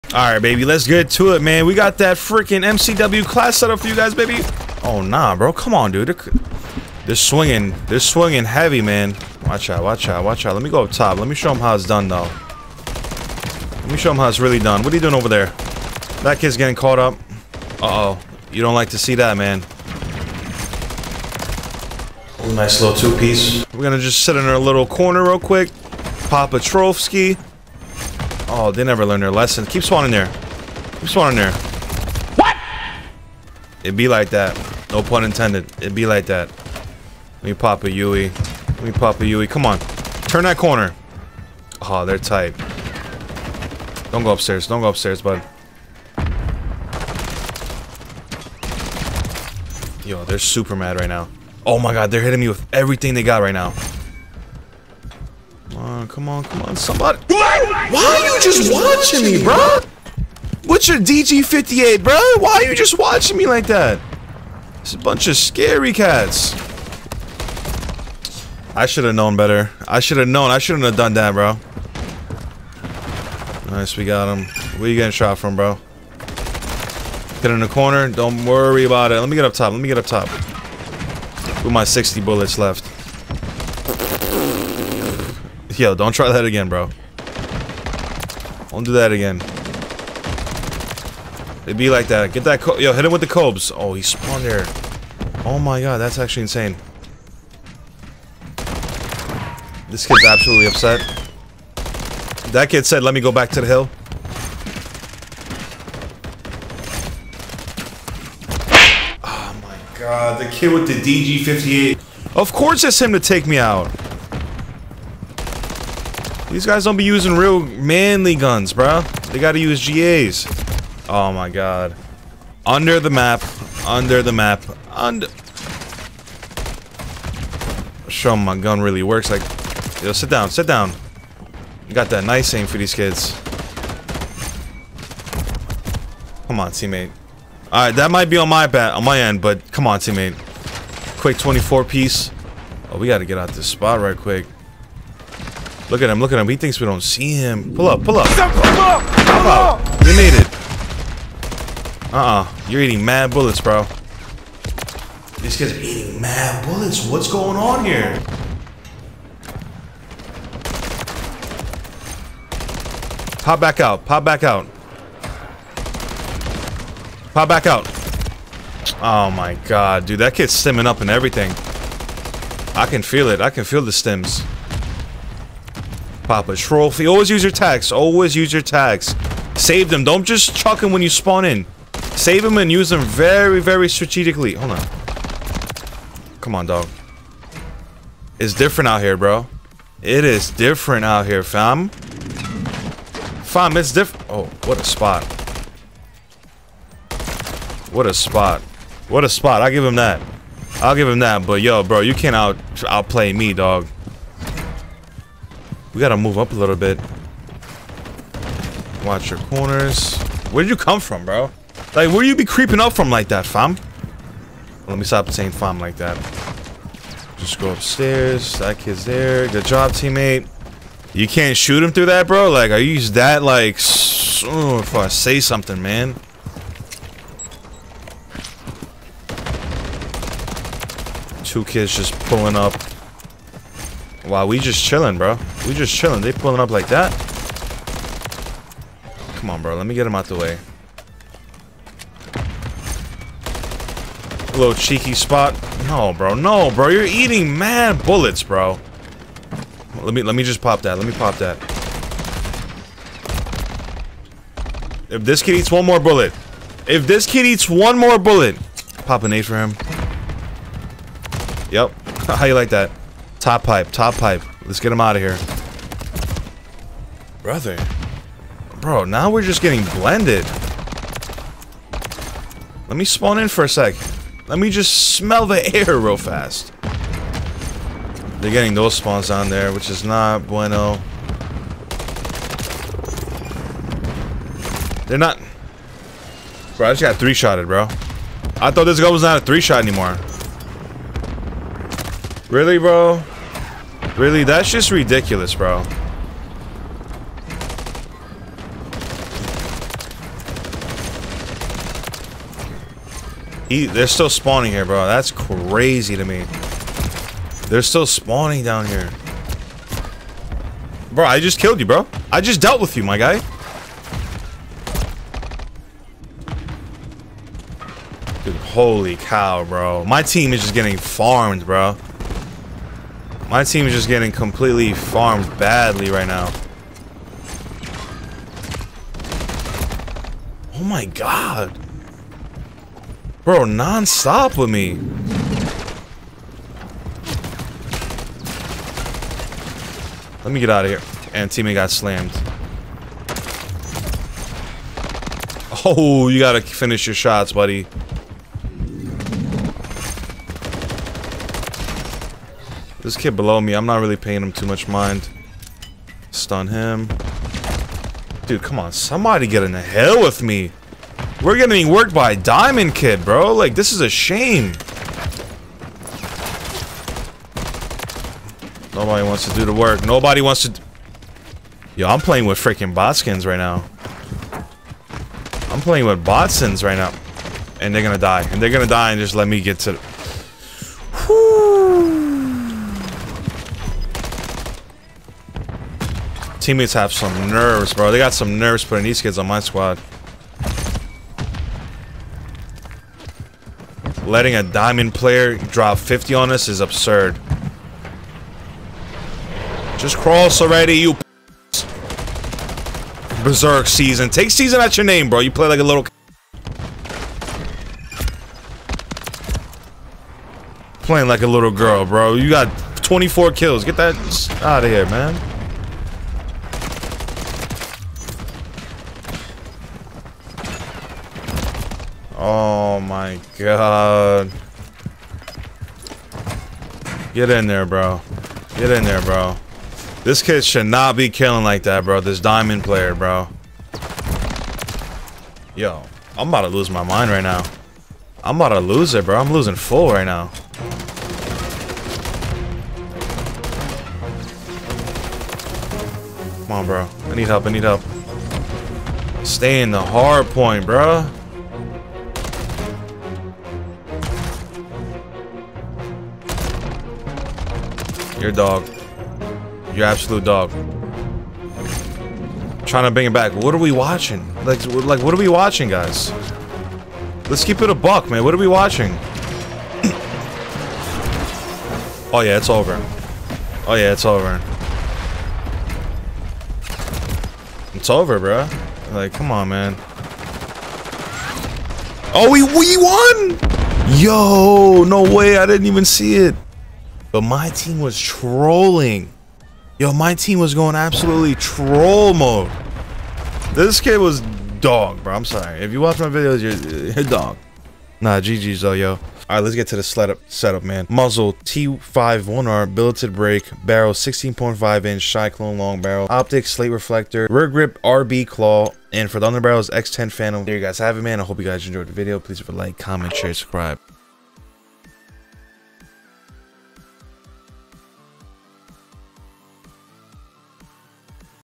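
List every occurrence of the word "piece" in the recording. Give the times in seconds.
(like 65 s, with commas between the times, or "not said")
22 s, 141 s.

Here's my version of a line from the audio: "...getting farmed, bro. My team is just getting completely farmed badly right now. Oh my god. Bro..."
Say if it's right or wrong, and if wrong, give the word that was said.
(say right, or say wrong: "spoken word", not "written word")
right.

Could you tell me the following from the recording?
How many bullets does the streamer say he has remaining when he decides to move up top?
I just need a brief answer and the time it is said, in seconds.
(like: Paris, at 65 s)
60, at 81 s.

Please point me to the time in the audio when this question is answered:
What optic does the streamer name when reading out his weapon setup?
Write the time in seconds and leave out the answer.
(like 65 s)
506 s.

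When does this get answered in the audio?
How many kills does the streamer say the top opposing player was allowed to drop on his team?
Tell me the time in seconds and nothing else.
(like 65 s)
395 s.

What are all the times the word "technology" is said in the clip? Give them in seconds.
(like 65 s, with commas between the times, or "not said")
not said.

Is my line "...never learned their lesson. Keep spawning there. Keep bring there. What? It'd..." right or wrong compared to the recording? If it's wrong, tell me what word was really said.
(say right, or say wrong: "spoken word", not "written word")
wrong: "spawning", not "bring".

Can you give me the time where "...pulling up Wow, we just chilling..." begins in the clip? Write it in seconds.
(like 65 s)
232 s.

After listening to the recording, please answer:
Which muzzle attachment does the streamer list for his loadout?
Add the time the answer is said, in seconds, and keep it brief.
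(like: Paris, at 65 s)
T51R Billeted Brake, at 501 s.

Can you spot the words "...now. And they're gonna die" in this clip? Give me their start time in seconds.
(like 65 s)
376 s.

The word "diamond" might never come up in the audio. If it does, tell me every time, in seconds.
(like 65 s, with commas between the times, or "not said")
362 s, 394 s, 432 s.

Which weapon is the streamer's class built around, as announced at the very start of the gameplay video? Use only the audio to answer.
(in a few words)
MCW.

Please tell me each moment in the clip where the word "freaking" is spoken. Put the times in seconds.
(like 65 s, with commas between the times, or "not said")
2 s, 372 s.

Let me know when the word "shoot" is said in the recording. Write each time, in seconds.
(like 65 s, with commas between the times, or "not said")
221 s.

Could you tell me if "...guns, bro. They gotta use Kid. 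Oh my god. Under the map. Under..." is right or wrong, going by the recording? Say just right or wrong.
wrong.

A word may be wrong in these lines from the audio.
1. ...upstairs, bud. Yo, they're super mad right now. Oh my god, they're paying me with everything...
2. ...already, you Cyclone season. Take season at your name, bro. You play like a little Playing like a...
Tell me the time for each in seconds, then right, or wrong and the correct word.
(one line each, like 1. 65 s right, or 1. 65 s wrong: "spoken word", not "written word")
1. 44 s wrong: "hitting", not "paying"
2. 400 s wrong: "Berserk", not "Cyclone".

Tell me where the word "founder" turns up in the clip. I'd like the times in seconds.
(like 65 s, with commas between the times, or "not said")
not said.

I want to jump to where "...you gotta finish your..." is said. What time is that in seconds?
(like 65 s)
346 s.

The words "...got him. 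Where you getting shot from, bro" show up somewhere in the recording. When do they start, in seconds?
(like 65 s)
74 s.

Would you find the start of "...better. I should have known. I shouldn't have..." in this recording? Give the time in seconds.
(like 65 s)
69 s.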